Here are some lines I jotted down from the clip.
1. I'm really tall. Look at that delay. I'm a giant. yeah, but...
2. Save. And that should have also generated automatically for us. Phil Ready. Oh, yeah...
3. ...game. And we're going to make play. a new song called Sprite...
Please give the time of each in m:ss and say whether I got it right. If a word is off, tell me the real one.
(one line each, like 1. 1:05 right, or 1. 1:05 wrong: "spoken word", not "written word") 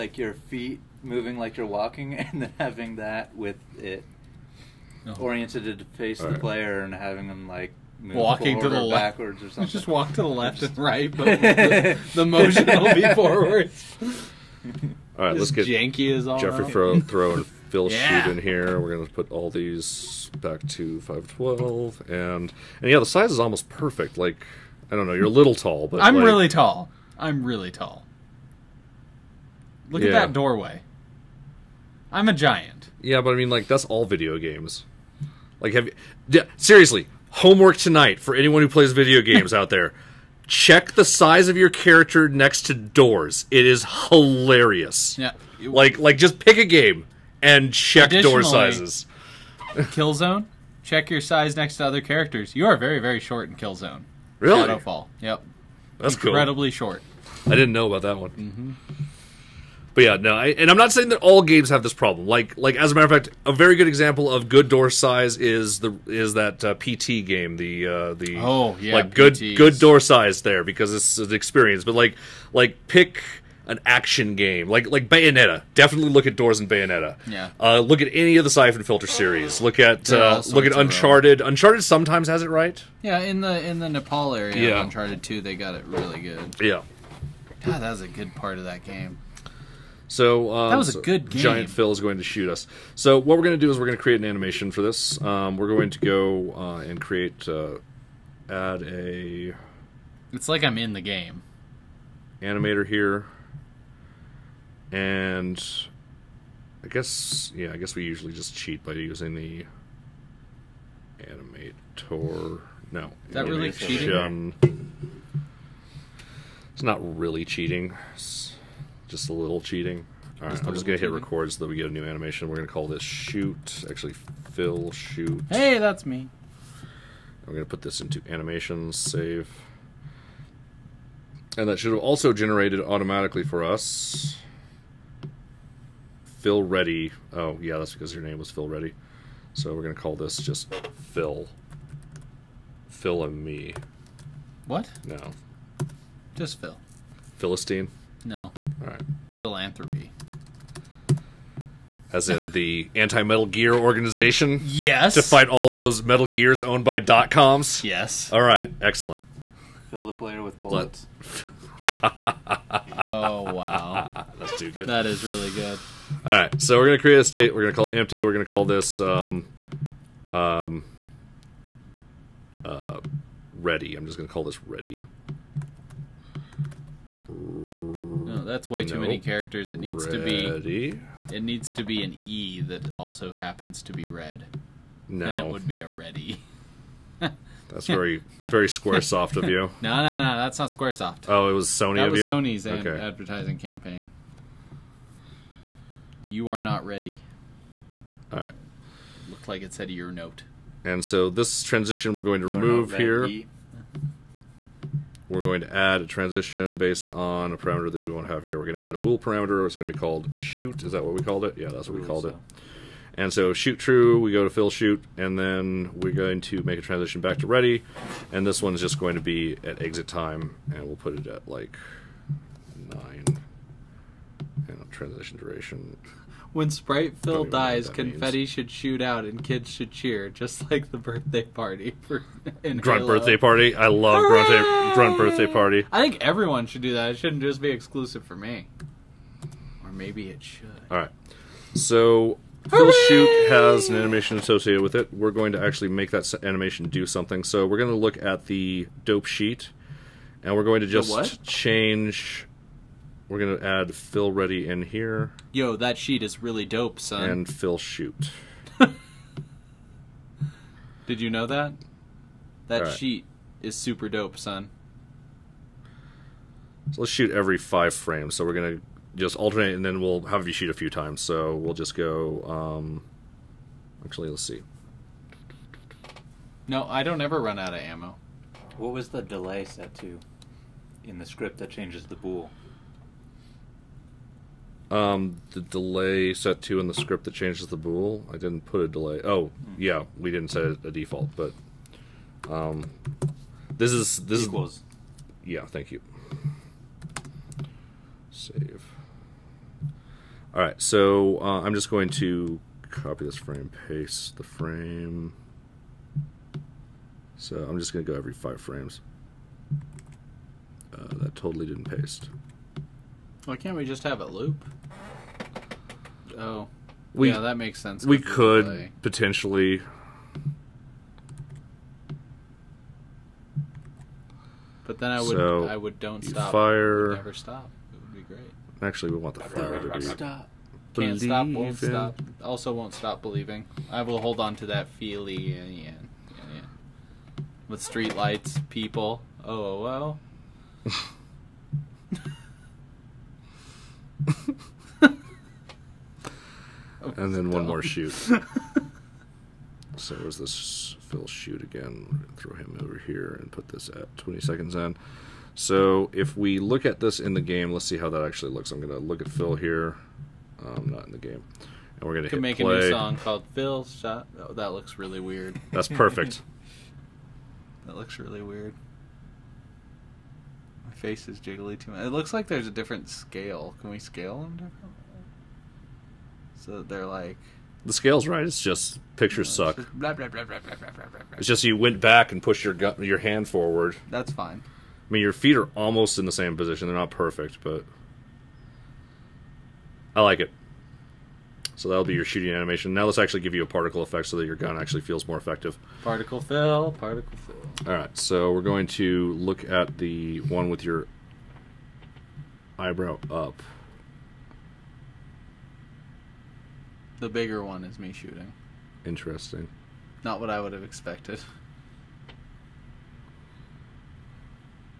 1. 0:27 wrong: "doorway", not "delay"
2. 2:08 right
3. 6:01 wrong: "Phil", not "Sprite".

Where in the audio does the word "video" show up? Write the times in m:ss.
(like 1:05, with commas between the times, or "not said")
0:34, 0:38.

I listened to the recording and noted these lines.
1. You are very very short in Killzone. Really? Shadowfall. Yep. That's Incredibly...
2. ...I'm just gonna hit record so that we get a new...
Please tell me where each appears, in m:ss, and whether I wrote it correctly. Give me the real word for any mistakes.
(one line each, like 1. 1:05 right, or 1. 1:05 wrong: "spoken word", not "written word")
1. 0:52 right
2. 2:00 right.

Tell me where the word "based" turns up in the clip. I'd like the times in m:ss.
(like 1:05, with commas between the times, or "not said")
3:26.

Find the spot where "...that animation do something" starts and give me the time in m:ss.
4:06.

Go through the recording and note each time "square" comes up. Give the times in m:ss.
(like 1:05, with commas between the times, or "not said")
3:10.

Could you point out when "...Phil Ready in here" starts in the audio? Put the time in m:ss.
4:13.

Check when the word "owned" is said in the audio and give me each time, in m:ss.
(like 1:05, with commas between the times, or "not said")
2:36.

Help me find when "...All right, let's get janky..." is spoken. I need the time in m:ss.
0:15.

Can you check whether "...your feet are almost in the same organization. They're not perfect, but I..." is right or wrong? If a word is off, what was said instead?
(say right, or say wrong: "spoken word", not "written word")
wrong: "position", not "organization".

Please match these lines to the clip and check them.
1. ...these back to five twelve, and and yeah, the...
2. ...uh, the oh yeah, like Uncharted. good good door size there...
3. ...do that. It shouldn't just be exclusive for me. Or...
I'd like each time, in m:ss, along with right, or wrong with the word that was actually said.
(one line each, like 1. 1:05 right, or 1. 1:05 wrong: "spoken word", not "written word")
1. 0:19 right
2. 1:07 wrong: "PTs", not "Uncharted"
3. 3:56 right.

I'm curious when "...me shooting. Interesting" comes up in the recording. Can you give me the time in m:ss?
6:47.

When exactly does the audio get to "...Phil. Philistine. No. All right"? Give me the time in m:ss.
2:26.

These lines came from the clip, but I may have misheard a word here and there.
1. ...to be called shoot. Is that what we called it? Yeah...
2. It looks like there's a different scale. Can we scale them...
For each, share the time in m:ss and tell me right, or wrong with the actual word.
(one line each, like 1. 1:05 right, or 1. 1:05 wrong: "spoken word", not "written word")
1. 3:29 right
2. 6:12 right.